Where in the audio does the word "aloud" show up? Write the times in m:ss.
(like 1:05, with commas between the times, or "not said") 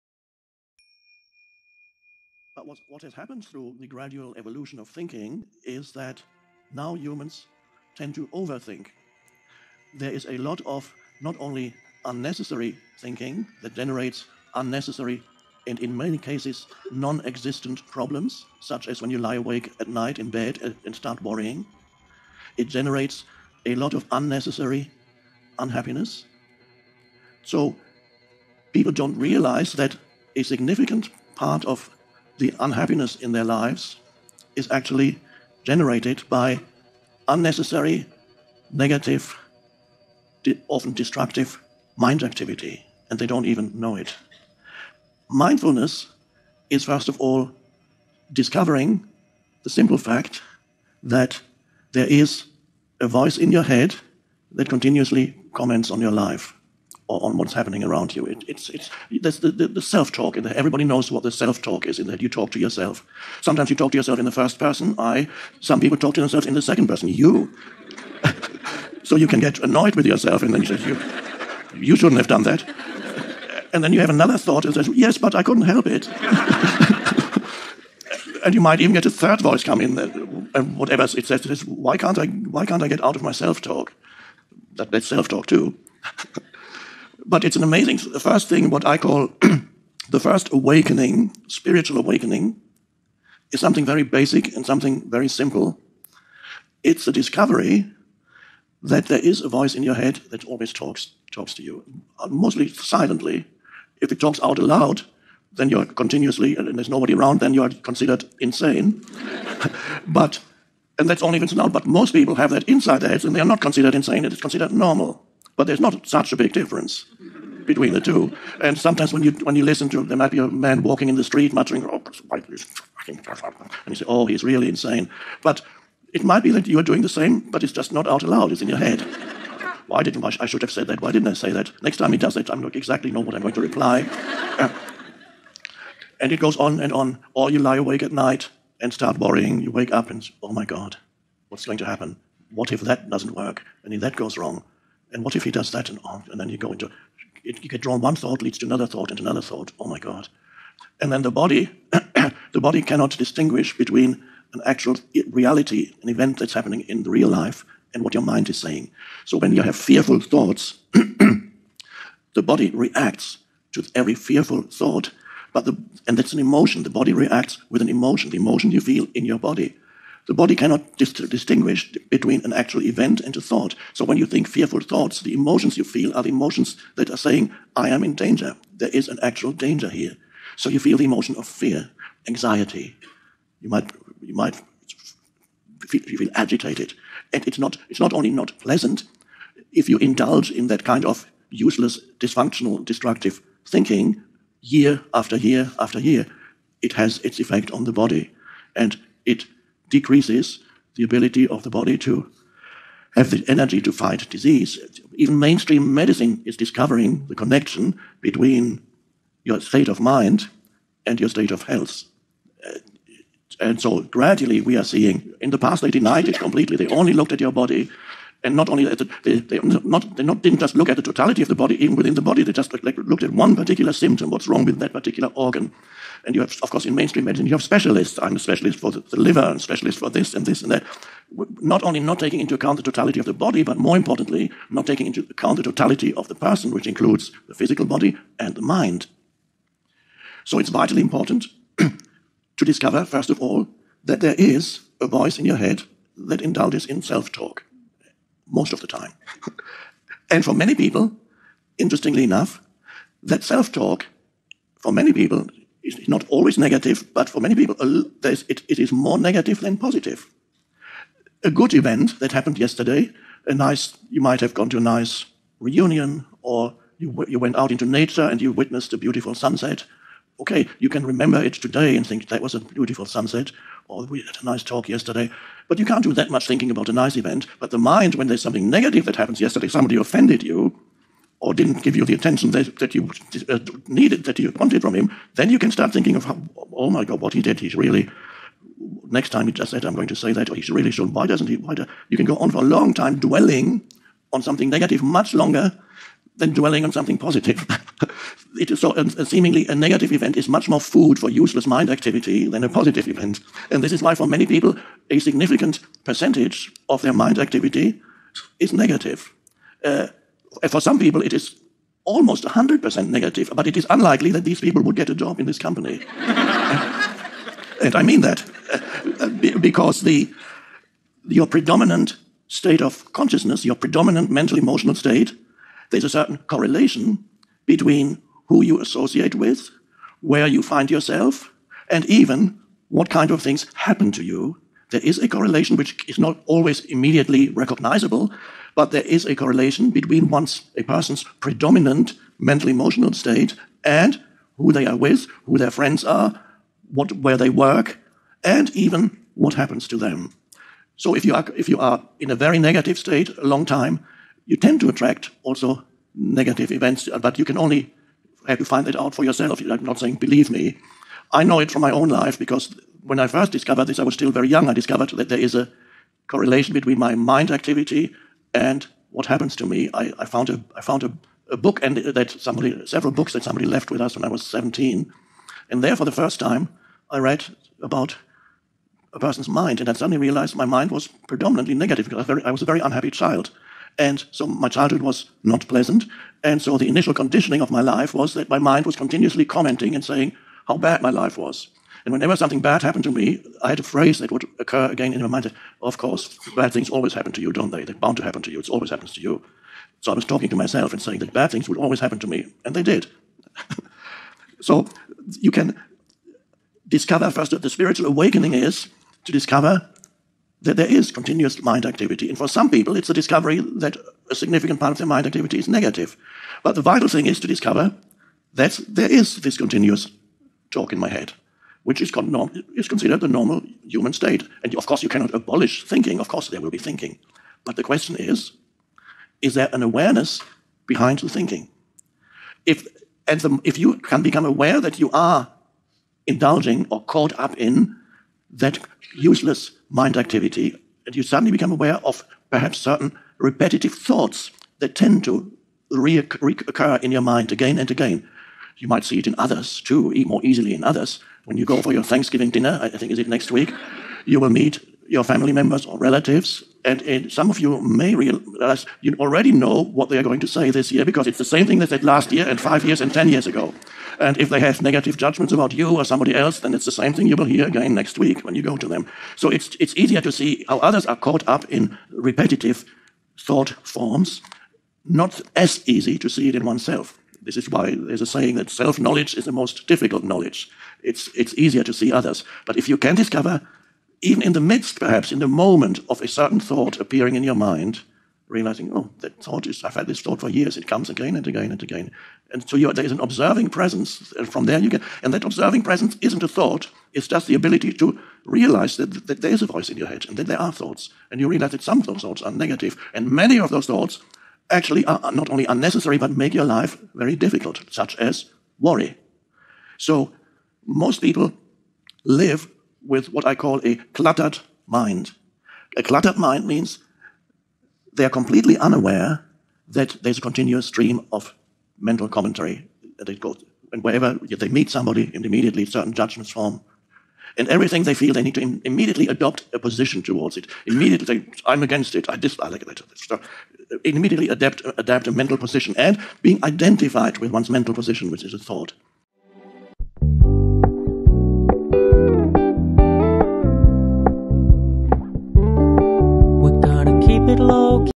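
1:44, 2:08.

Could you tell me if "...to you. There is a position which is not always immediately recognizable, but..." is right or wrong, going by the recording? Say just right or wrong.
wrong.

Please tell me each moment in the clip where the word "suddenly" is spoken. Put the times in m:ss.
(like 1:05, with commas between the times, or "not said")
6:19, 7:21.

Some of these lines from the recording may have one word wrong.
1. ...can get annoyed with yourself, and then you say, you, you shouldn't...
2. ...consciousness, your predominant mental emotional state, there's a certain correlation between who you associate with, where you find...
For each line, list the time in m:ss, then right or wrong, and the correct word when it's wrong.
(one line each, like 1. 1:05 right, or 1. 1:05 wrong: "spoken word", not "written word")
1. 1:09 right
2. 5:23 right.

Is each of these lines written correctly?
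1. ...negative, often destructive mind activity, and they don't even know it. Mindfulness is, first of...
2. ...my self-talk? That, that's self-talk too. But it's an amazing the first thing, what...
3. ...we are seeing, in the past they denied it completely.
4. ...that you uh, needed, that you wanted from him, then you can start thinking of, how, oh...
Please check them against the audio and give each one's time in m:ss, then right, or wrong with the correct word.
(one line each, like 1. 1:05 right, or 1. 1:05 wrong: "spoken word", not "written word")
1. 0:38 right
2. 1:23 right
3. 3:34 right
4. 4:42 right.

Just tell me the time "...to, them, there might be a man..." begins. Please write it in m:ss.
1:59.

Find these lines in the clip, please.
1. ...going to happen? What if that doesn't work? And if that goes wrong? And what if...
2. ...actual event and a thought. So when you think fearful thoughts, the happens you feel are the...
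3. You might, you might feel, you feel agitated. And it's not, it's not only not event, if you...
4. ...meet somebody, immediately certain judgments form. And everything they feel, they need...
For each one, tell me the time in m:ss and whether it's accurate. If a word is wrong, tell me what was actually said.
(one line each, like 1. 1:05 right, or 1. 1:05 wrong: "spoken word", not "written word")
1. 2:21 right
2. 2:52 wrong: "emotions", not "happens"
3. 3:03 wrong: "pleasant", not "event"
4. 8:44 right.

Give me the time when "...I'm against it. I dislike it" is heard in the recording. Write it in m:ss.
8:51.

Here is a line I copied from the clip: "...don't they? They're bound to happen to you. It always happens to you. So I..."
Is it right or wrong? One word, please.
right.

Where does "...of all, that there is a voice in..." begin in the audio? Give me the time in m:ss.
4:03.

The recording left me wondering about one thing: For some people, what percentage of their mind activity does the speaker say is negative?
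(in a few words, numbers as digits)
almost 100%.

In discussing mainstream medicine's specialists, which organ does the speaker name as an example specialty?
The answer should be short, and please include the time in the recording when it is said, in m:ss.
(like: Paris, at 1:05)
the liver, at 3:49.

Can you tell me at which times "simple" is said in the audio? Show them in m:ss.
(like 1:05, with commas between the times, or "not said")
0:49, 1:35.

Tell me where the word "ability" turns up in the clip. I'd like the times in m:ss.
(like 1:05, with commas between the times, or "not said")
3:21, 8:17.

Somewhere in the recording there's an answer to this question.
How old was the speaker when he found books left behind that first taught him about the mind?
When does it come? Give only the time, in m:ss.
6:14.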